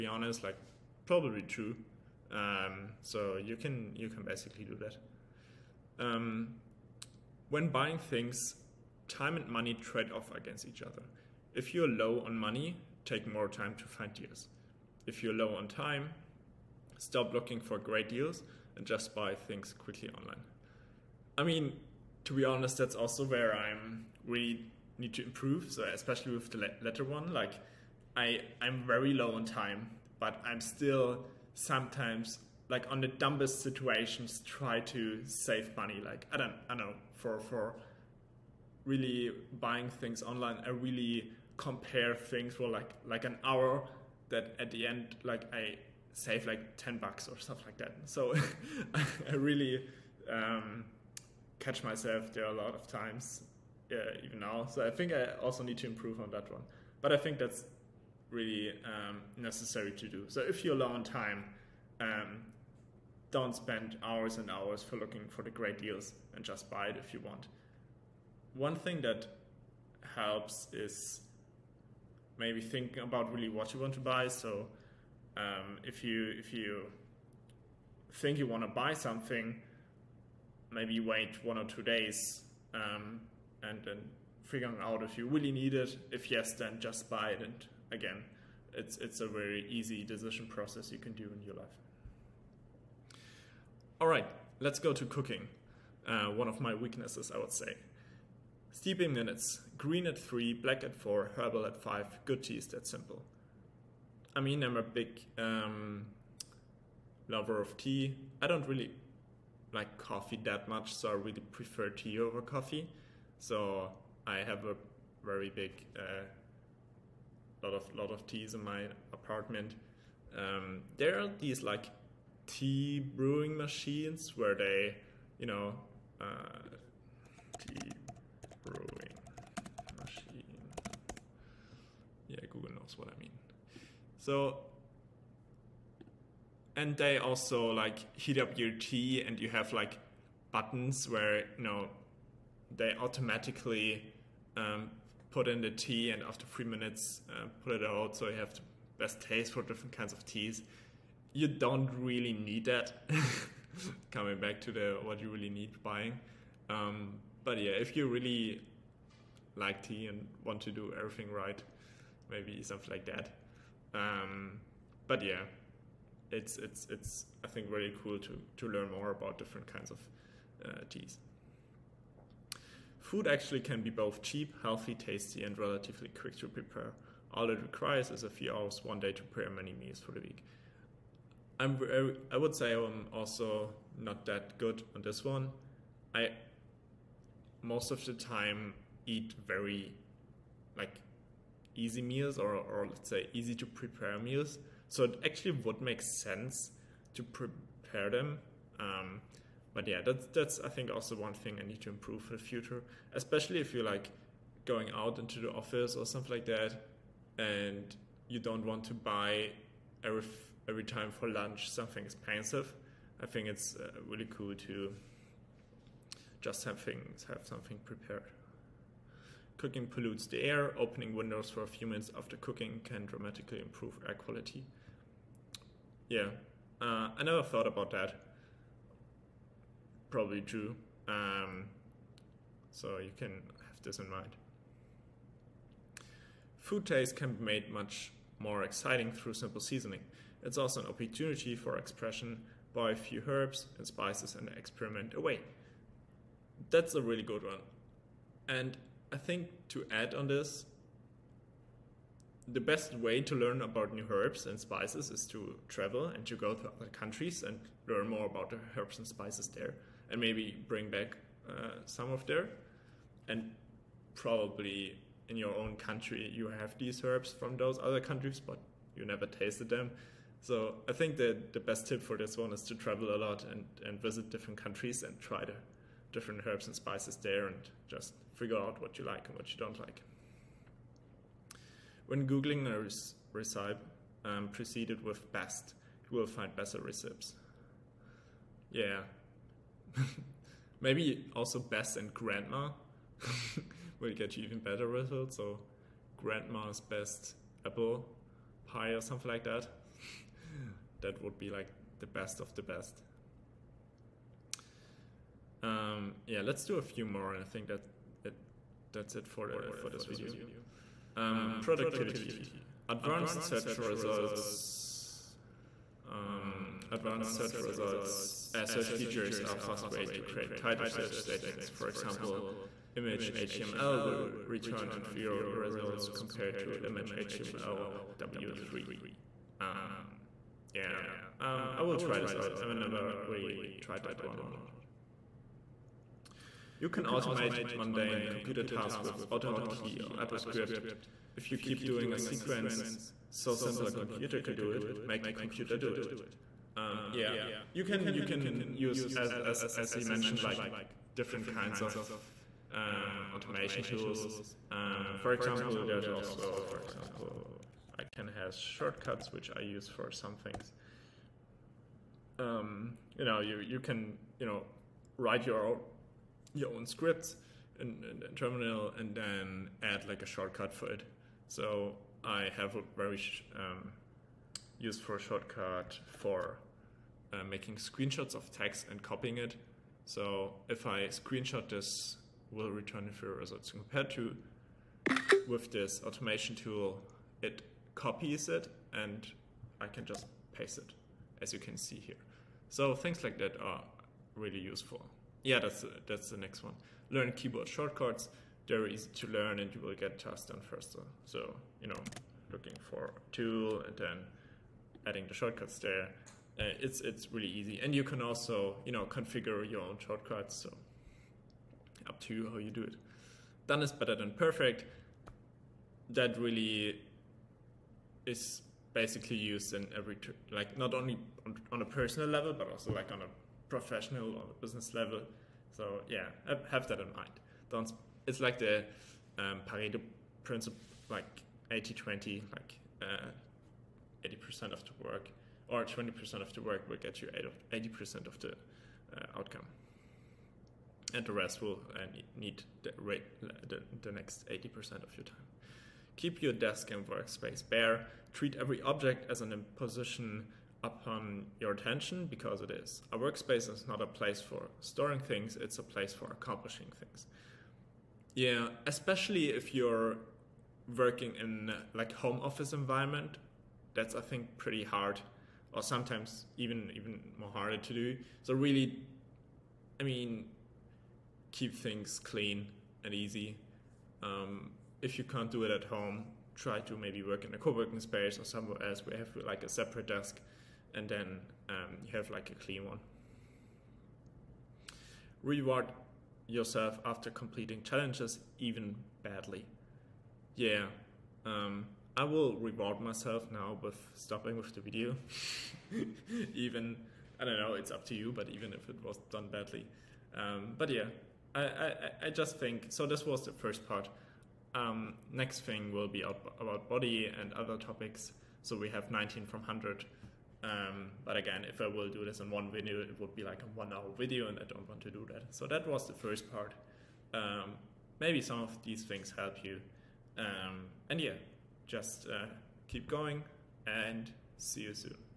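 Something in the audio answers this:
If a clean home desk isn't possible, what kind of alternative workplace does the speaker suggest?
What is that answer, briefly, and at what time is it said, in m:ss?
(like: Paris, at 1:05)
co-working space, at 7:57.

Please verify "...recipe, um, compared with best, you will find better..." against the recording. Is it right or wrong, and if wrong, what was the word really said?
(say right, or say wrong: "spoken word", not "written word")
wrong: "preceded", not "compared".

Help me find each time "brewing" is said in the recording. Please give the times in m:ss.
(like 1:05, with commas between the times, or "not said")
2:02, 2:08.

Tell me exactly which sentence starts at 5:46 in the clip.
Um, yeah, you can you can use as as as he mentioned like different kinds of um, automation tools.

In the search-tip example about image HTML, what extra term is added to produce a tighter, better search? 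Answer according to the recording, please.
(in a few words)
W3.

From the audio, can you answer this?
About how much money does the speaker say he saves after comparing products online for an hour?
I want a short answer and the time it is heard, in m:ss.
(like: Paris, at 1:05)
10 bucks, at 0:46.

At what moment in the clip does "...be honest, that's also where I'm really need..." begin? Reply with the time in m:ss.
0:22.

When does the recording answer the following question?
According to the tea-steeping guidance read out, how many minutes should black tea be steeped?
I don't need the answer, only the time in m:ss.
1:40.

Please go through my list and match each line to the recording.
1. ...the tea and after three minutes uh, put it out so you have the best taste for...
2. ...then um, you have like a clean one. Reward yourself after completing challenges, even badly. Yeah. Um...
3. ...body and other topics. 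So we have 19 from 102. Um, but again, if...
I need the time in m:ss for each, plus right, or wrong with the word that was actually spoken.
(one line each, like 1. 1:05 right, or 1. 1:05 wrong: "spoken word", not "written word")
1. 2:25 right
2. 8:01 right
3. 8:26 wrong: "100", not "102".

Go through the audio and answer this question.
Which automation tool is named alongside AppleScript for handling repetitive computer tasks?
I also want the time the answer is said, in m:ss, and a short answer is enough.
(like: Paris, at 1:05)
AutoHotkey, at 5:39.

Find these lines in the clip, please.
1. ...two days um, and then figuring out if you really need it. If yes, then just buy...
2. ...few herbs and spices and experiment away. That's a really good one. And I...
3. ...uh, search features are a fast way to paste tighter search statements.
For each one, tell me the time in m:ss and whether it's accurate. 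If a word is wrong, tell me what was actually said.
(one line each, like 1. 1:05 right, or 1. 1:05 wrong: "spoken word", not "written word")
1. 1:21 right
2. 4:02 right
3. 5:18 wrong: "create", not "paste".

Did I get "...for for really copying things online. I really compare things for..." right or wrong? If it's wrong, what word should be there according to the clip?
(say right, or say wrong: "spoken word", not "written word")
wrong: "buying", not "copying".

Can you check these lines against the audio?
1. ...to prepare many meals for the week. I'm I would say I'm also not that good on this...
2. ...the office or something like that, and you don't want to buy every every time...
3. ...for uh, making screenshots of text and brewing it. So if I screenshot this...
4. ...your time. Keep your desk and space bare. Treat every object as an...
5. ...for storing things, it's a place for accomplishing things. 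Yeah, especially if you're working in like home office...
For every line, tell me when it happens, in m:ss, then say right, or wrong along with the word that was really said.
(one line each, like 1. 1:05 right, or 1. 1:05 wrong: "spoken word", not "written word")
1. 2:59 right
2. 3:25 right
3. 6:16 wrong: "copying", not "brewing"
4. 7:25 wrong: "workspace", not "space"
5. 7:34 right.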